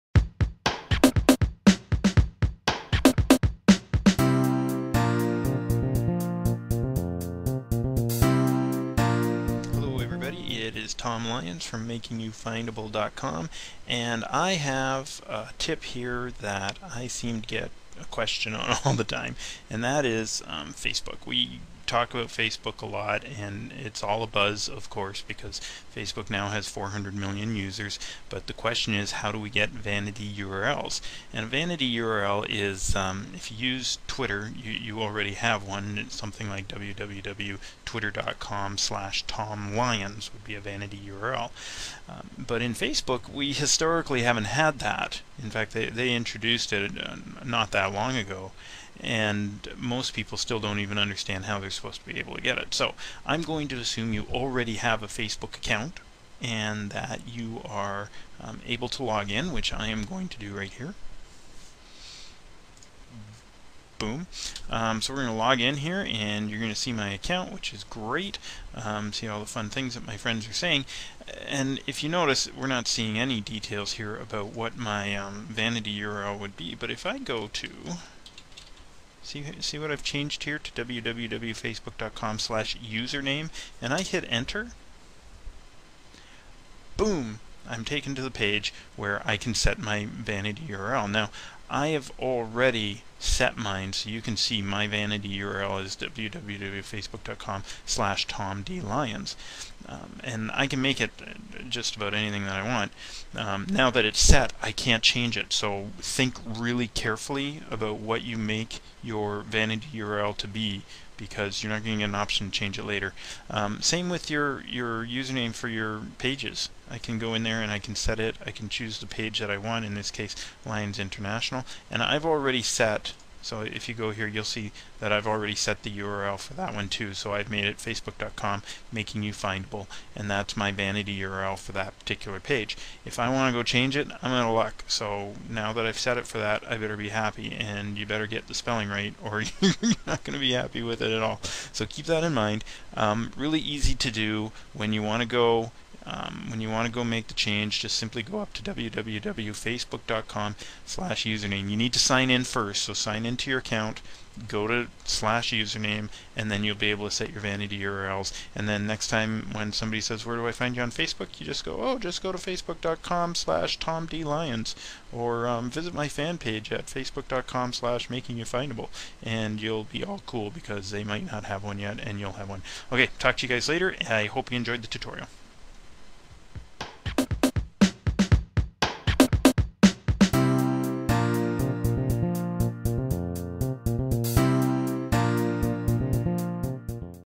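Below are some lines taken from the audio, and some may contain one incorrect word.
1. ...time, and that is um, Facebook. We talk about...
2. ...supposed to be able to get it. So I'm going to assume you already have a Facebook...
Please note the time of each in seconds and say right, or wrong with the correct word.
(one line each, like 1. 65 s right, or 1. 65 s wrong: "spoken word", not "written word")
1. 19 s right
2. 51 s right.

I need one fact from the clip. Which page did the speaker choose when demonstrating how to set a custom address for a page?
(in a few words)
Lions International.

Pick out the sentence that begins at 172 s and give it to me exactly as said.
Okay, talk to you guys later.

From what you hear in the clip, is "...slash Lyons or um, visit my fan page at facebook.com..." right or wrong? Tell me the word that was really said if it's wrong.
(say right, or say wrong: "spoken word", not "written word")
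right.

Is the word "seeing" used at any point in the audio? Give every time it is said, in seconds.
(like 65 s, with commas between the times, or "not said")
72 s.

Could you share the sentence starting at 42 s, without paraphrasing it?
Um, but in Facebook, we historically haven't had that.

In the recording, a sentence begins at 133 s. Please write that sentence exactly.
If I want to go change it, I'm out of luck.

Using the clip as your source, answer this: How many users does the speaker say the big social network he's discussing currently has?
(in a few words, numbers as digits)
400 million.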